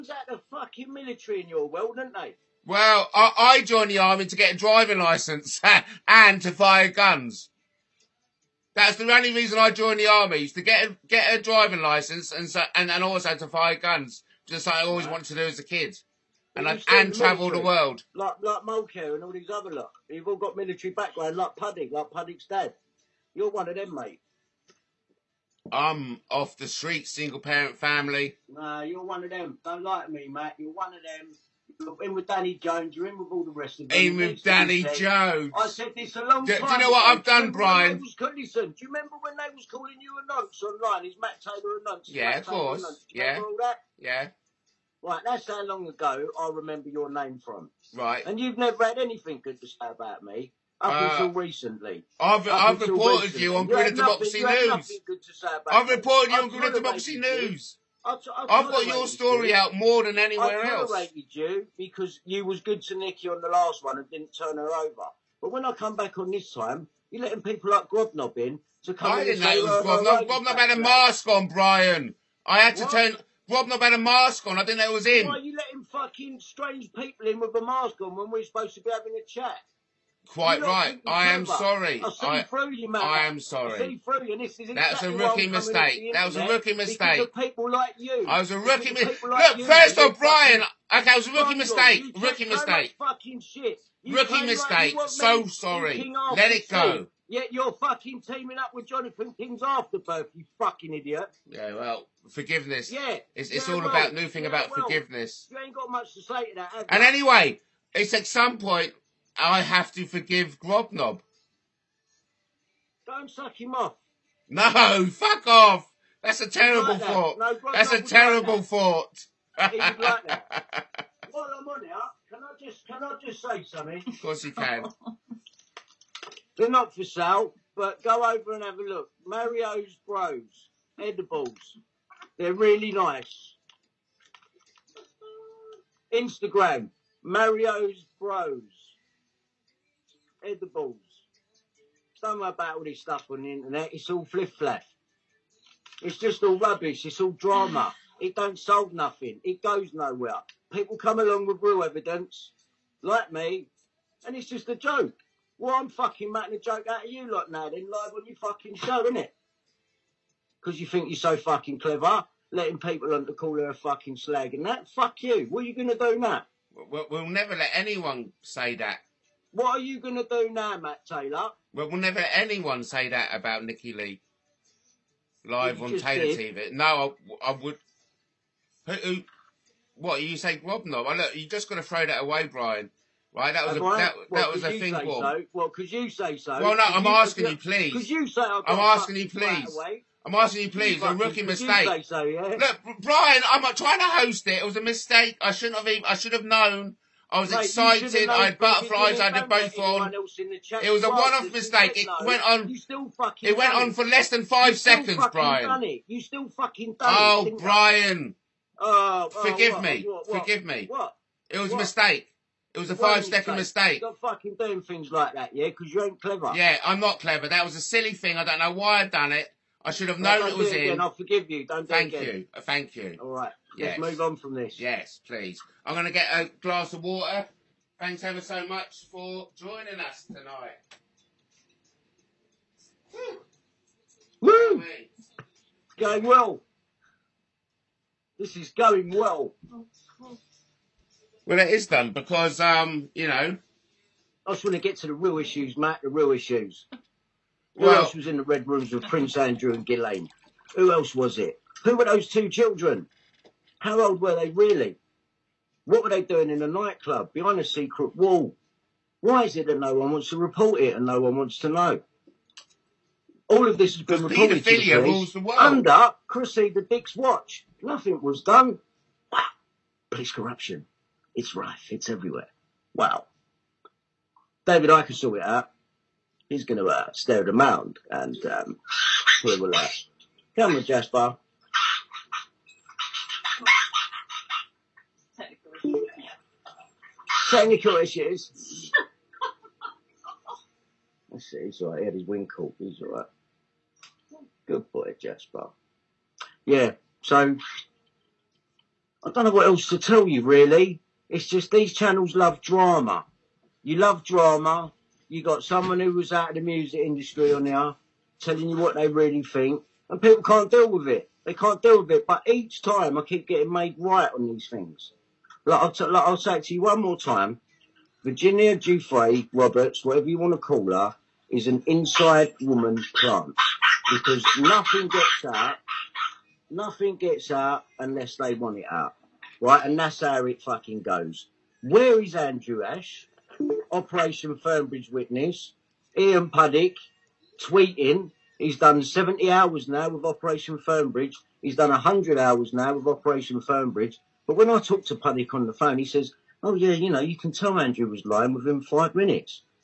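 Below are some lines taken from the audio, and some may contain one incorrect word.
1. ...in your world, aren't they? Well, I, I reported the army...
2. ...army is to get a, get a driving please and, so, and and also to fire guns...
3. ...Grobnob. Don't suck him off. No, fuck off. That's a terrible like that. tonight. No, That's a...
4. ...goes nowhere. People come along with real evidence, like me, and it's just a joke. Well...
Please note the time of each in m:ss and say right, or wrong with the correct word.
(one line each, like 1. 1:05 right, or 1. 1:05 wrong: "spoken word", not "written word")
1. 0:01 wrong: "joined", not "reported"
2. 0:10 wrong: "license", not "please"
3. 1:50 wrong: "thought", not "tonight"
4. 2:29 right.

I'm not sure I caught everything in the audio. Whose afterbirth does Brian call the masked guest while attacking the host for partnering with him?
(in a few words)
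Jonathan King.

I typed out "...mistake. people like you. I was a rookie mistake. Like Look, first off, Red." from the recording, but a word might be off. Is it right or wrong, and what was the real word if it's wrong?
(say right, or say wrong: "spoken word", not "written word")
wrong: "Brian", not "Red".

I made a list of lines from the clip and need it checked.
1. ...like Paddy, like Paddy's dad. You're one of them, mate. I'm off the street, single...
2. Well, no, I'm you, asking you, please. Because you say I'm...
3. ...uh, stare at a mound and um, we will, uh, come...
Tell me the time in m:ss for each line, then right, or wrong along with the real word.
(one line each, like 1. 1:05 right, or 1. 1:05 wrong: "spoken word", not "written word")
1. 0:21 right
2. 3:06 right
3. 4:36 right.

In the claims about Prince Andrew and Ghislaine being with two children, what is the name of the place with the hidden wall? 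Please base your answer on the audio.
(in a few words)
Red Rooms.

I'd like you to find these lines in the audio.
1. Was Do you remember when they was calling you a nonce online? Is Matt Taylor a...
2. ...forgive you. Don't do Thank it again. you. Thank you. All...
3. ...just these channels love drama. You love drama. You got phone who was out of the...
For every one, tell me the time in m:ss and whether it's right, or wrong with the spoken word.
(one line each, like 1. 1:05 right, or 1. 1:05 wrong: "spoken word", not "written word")
1. 0:37 right
2. 3:41 right
3. 5:01 wrong: "someone", not "phone".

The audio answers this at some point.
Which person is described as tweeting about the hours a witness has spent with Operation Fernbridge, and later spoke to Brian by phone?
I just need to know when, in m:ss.
5:36.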